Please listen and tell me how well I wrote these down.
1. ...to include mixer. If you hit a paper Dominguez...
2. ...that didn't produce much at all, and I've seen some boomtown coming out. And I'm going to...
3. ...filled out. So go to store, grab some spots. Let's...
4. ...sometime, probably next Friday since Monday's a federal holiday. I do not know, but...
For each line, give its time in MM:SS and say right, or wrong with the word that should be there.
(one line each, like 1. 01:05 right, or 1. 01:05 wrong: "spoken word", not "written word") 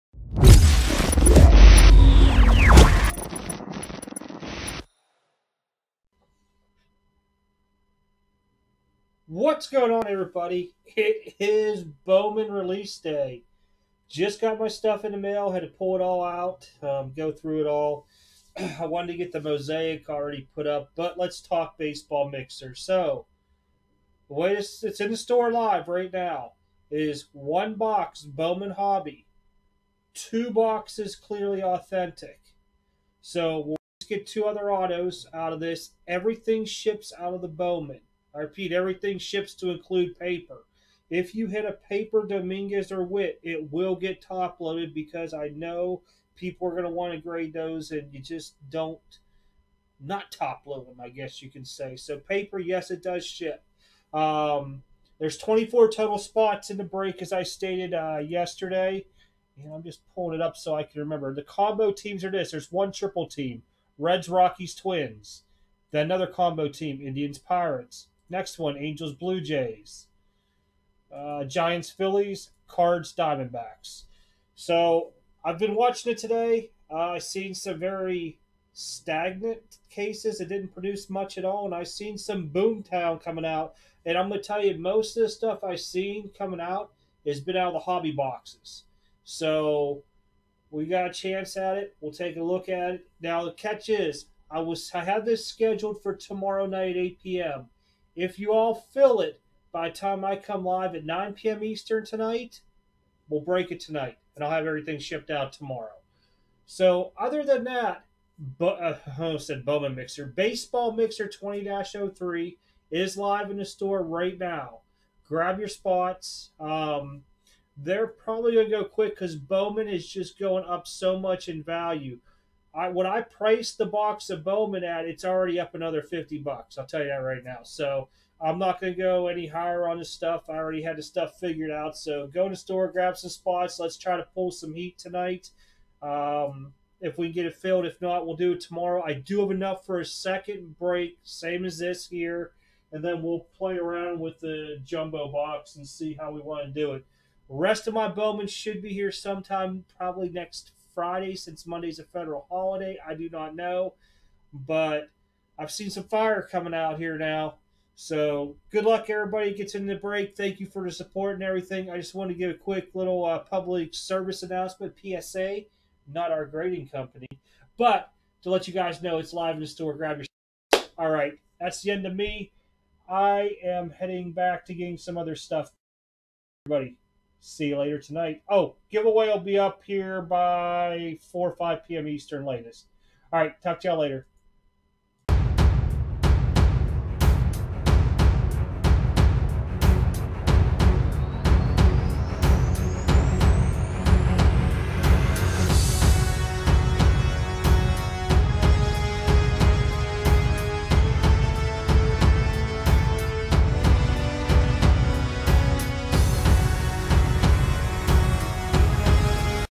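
1. 00:39 wrong: "paper", not "mixer"
2. 01:20 right
3. 02:11 wrong: "figured", not "filled"
4. 02:29 right.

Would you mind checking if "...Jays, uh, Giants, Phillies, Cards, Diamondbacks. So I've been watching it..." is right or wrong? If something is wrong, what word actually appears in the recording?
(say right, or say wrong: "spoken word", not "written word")
right.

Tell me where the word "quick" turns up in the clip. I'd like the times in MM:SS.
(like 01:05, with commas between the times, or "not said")
01:58, 02:42.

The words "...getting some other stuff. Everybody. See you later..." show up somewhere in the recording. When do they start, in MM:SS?
02:54.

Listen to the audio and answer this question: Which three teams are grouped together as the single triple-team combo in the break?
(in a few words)
Reds, Rockies, Twins.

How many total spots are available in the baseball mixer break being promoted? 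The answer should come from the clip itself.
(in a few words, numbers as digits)
24.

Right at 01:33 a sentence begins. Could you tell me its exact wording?
Now the catch is, I was I had this scheduled for tomorrow night 8 p.m.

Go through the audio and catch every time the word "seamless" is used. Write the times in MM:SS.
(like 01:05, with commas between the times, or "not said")
not said.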